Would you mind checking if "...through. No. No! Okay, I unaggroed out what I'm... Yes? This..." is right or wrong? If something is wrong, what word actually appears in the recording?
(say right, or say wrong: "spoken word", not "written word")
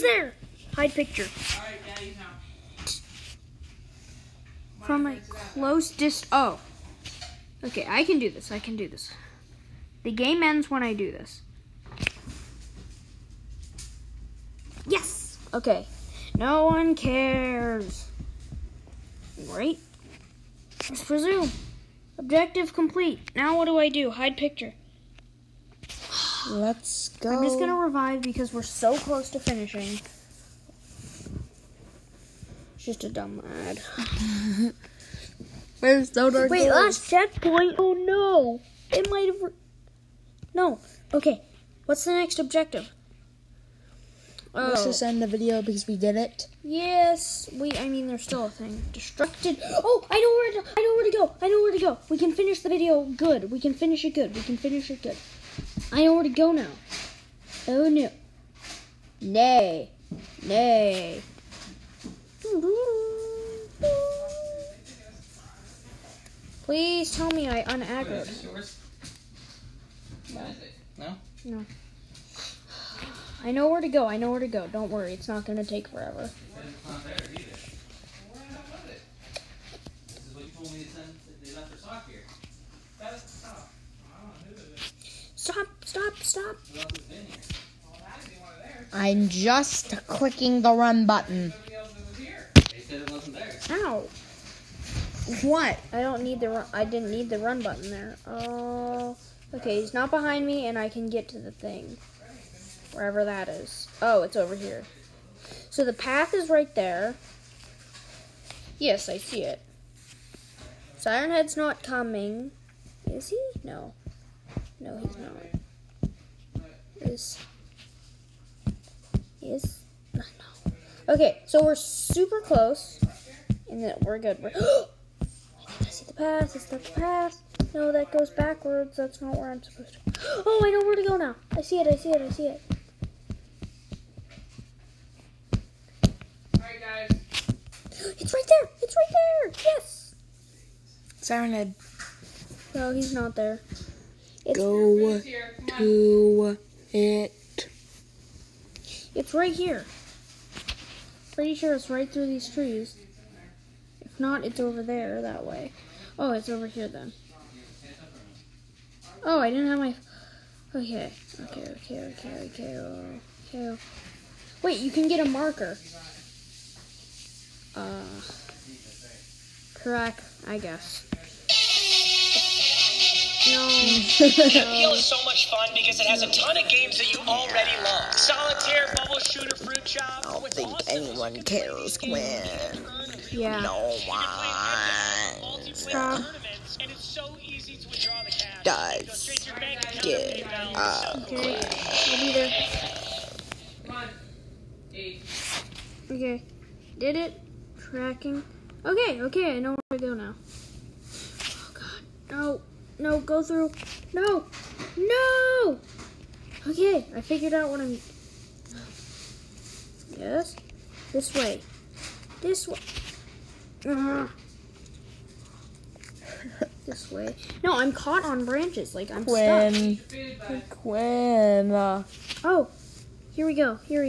wrong: "figured", not "unaggroed".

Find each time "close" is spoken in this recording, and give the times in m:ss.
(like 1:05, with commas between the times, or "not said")
0:05, 0:28, 2:02.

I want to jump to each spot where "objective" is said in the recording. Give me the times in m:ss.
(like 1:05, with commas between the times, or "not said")
0:22, 0:42.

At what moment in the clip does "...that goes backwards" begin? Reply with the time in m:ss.
2:07.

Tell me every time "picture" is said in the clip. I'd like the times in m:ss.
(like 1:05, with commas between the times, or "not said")
0:00, 0:24.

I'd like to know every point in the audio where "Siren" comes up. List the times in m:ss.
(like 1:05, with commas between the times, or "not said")
1:50, 2:21.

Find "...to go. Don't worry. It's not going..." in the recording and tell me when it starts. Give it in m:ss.
1:14.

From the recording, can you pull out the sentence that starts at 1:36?
I didn't need the run button there.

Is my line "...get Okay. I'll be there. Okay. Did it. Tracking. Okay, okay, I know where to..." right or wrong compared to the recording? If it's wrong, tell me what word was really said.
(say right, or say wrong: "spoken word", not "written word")
right.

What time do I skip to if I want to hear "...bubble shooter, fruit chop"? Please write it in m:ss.
2:58.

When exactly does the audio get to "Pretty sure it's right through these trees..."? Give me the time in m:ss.
2:31.